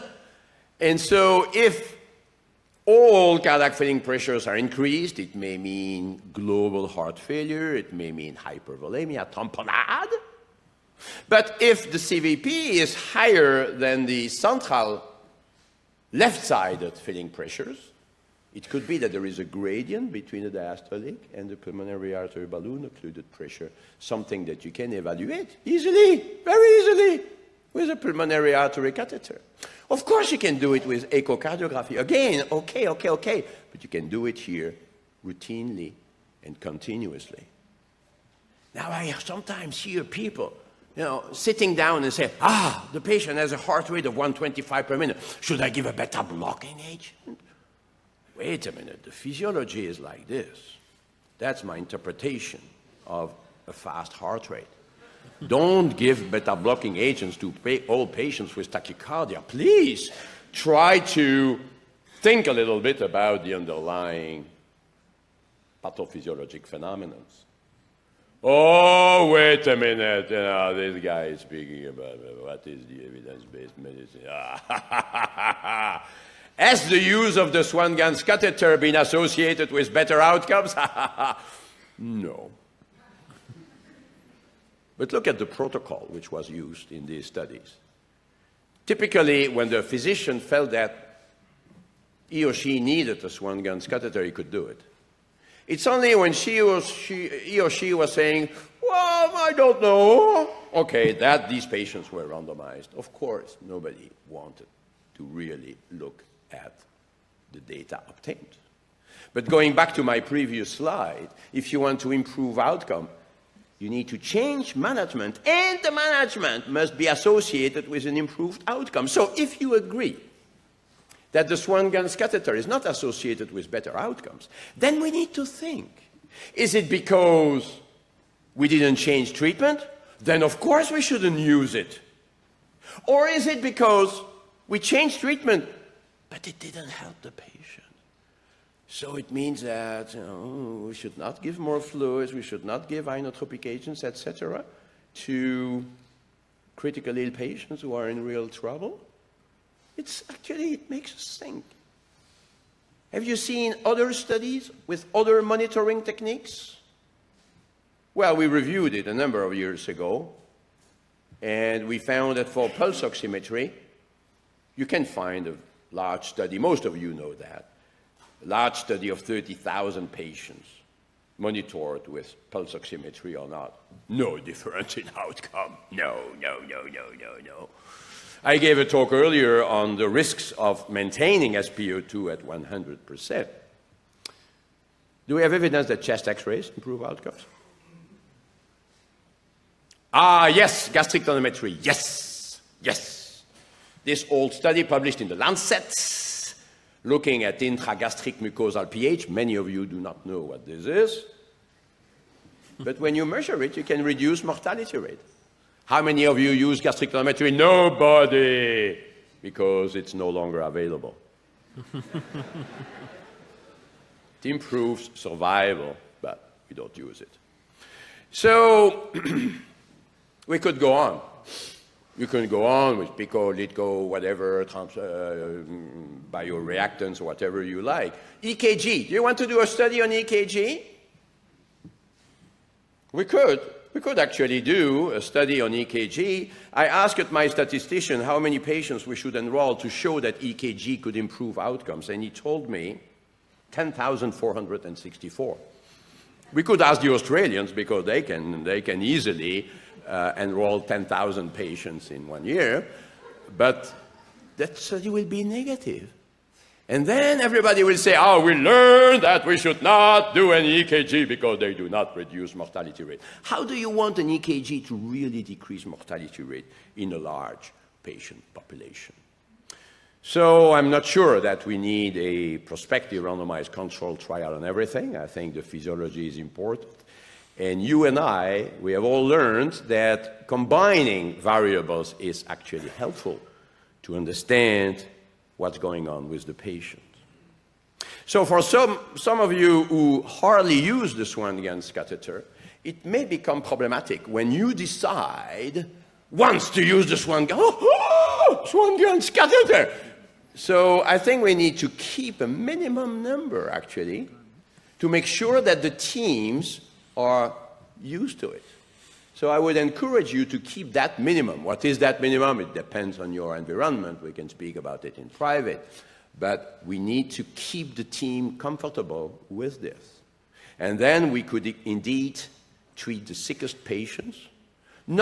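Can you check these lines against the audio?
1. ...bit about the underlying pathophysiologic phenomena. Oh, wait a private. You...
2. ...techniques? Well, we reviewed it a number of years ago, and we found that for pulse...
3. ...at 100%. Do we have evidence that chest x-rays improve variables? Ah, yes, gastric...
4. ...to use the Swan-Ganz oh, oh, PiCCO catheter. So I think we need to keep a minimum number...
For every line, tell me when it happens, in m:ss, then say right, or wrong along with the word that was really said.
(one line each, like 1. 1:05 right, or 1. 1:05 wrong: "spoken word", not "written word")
1. 1:02 wrong: "minute", not "private"
2. 2:36 right
3. 3:02 wrong: "outcomes", not "variables"
4. 4:56 wrong: "Swan", not "PiCCO".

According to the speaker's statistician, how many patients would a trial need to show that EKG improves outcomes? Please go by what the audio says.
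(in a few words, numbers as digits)
10,464.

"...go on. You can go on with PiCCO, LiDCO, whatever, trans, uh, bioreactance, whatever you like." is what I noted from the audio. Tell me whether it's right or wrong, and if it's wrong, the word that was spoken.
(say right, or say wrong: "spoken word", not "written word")
right.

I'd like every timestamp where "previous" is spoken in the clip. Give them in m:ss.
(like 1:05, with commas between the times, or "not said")
1:50.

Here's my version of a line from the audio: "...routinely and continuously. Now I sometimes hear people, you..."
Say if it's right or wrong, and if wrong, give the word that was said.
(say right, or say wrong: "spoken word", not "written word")
right.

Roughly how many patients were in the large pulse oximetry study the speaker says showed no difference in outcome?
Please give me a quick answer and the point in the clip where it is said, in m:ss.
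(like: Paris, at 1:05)
30,000, at 2:49.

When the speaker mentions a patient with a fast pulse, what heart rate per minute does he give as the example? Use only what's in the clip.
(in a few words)
125.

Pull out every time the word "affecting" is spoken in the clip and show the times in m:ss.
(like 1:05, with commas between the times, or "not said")
not said.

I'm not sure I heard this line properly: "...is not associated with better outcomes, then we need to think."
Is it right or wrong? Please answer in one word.
right.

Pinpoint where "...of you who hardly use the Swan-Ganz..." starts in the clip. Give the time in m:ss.
4:49.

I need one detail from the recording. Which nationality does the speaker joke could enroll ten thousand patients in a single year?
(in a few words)
Australians.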